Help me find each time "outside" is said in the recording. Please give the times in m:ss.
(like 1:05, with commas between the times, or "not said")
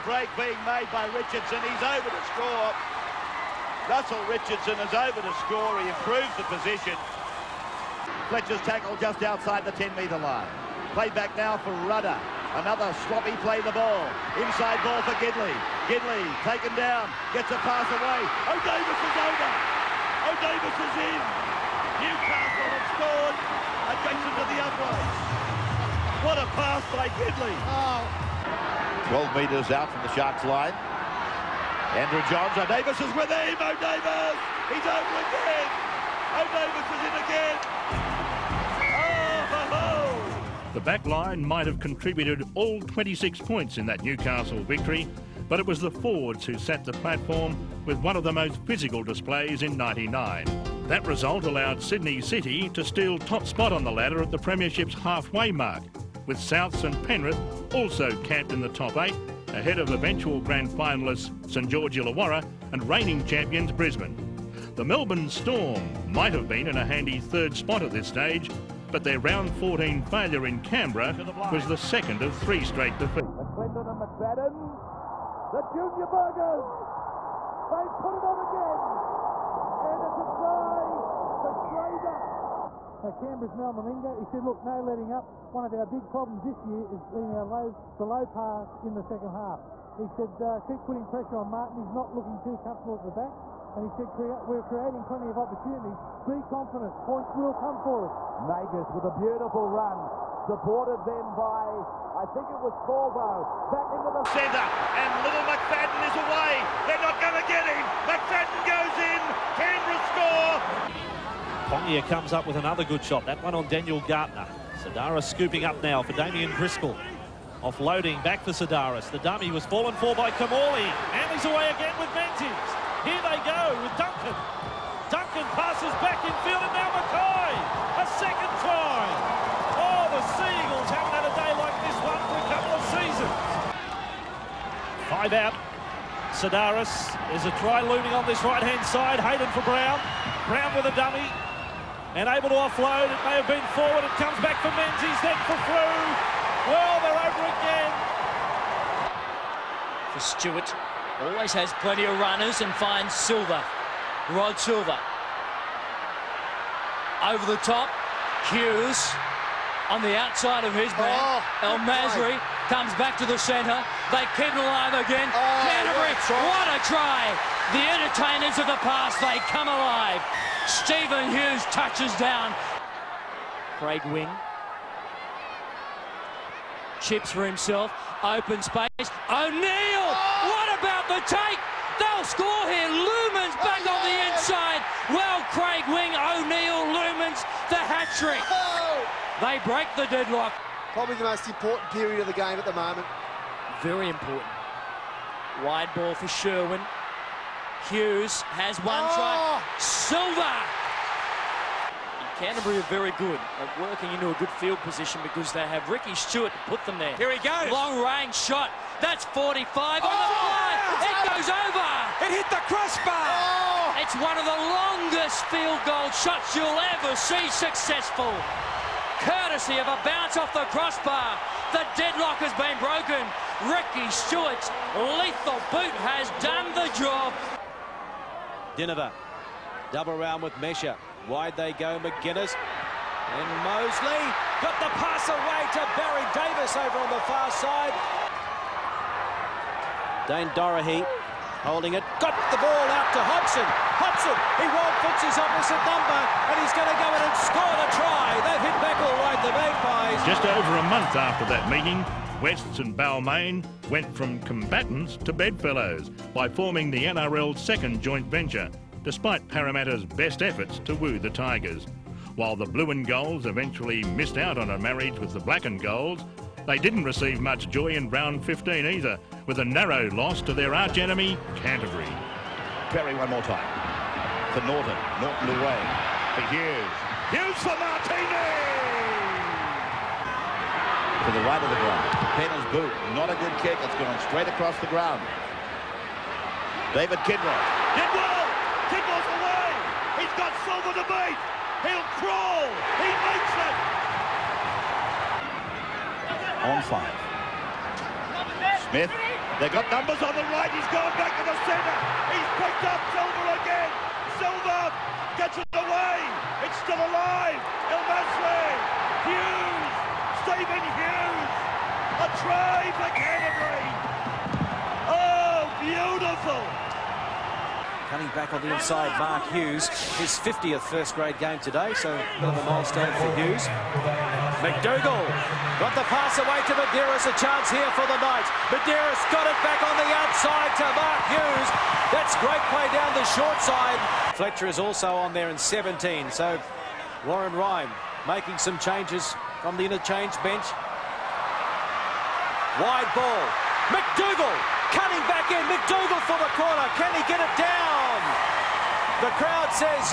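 0:09, 2:40, 5:30.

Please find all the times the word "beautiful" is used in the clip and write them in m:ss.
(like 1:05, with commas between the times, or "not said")
1:39, 5:15.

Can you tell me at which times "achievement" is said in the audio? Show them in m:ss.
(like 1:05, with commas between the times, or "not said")
not said.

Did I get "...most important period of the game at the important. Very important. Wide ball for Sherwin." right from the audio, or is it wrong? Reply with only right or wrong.
wrong.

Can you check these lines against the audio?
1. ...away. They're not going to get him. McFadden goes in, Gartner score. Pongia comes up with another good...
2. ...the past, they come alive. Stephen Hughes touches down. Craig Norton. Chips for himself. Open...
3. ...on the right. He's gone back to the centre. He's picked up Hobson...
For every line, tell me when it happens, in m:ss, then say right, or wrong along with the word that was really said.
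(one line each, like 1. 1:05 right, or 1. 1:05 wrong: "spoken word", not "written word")
1. 1:46 wrong: "Canberra", not "Gartner"
2. 2:48 wrong: "Wing", not "Norton"
3. 5:00 wrong: "Silva", not "Hobson".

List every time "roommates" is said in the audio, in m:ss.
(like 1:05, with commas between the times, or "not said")
not said.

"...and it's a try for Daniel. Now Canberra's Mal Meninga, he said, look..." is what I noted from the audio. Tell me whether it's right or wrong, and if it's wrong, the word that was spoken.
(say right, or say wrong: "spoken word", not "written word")
wrong: "Schrader", not "Daniel".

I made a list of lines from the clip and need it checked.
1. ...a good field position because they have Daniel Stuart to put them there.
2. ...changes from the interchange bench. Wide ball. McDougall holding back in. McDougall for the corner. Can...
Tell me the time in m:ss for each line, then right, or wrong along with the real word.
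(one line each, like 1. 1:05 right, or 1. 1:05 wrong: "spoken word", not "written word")
1. 3:24 wrong: "Ricky", not "Daniel"
2. 5:38 wrong: "cutting", not "holding".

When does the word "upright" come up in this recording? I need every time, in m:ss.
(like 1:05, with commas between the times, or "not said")
0:24.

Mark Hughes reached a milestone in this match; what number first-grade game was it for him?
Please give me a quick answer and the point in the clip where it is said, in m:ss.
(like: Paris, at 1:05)
50, at 5:20.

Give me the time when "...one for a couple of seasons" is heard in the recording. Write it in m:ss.
2:12.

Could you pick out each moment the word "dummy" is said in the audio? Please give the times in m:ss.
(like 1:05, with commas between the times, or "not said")
1:59, 2:20.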